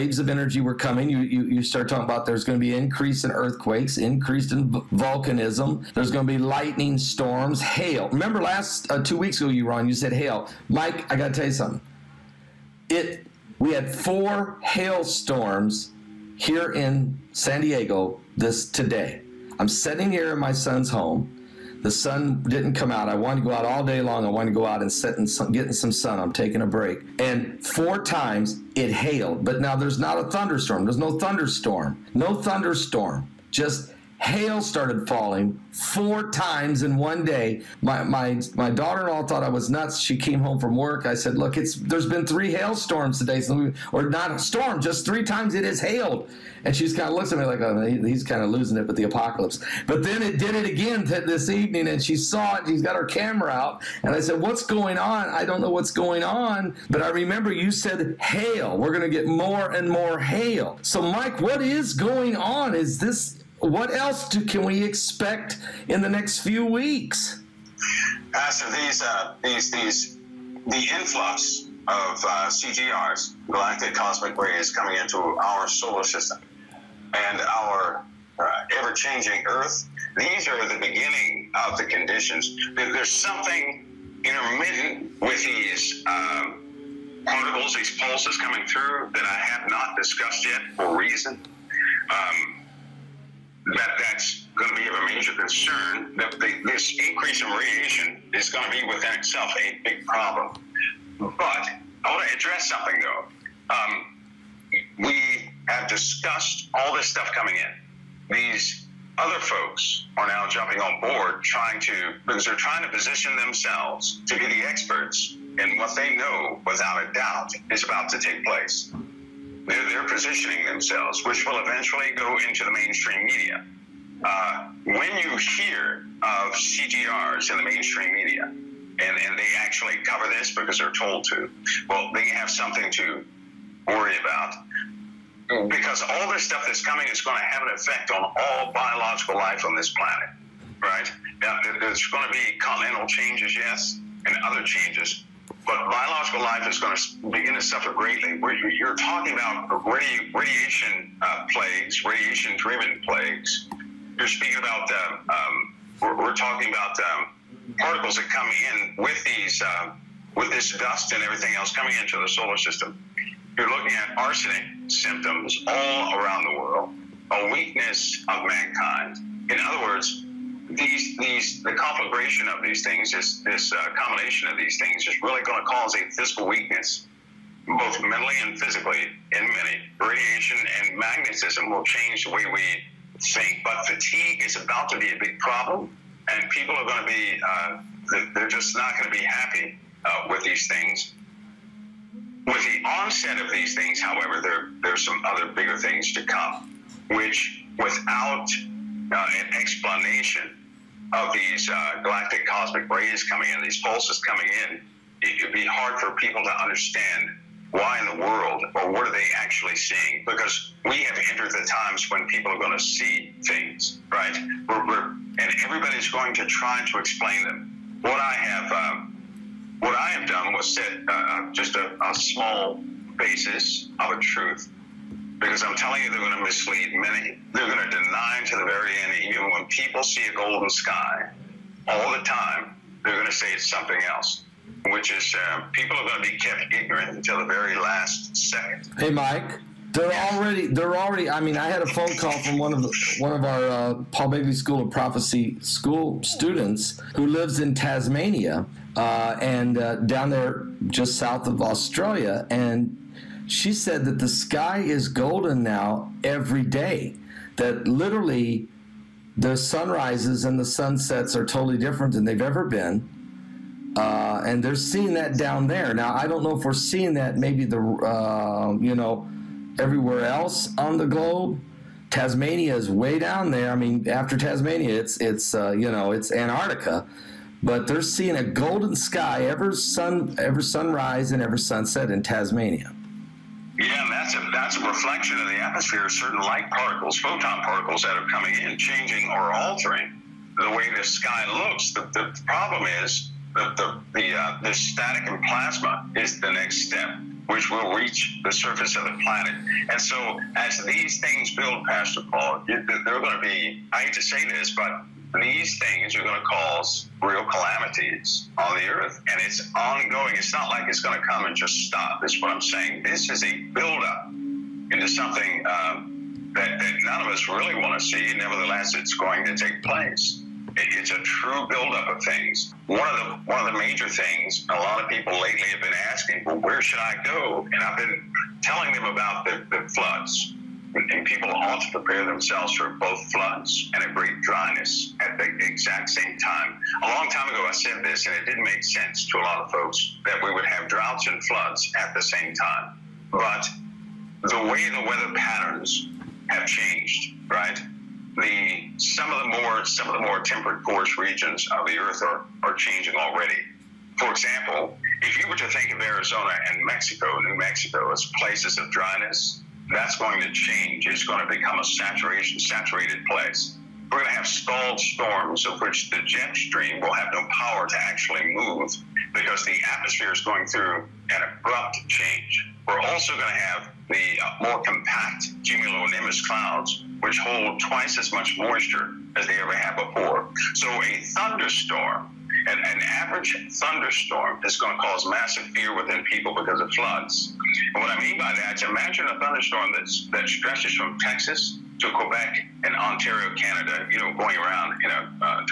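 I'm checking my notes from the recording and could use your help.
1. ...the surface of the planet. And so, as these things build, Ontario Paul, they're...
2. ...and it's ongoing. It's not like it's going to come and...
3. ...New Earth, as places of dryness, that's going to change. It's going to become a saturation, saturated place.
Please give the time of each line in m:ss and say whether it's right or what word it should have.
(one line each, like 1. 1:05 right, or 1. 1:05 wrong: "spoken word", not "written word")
1. 4:58 wrong: "Pastor", not "Ontario"
2. 5:09 right
3. 5:57 wrong: "Mexico", not "Earth".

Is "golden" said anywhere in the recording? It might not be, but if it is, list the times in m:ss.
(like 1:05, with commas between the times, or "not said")
3:50, 4:15, 4:38.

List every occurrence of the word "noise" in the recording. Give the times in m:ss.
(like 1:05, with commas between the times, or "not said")
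not said.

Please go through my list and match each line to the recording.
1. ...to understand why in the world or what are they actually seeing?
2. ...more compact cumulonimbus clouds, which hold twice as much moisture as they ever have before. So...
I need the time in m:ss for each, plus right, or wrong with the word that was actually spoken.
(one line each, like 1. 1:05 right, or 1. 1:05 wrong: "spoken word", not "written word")
1. 3:26 right
2. 6:14 right.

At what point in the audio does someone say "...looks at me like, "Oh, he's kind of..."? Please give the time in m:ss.
0:47.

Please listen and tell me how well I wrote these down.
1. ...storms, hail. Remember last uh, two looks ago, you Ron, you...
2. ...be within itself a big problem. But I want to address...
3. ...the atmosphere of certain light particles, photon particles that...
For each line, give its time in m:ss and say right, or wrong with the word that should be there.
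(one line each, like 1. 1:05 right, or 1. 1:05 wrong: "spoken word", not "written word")
1. 0:06 wrong: "weeks", not "looks"
2. 1:38 right
3. 4:45 right.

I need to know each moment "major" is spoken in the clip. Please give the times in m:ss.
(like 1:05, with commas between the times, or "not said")
1:35, 5:23.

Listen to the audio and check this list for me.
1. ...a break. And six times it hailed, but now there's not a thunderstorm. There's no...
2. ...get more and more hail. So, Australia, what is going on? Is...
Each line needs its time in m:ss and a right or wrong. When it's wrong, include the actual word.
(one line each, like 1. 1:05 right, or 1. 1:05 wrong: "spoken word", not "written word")
1. 0:26 wrong: "four", not "six"
2. 0:59 wrong: "Mike", not "Australia".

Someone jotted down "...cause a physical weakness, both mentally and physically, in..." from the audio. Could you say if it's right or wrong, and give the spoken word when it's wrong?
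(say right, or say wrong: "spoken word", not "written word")
right.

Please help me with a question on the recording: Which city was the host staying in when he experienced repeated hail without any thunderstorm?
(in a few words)
San Diego.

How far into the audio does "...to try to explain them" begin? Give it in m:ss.
3:36.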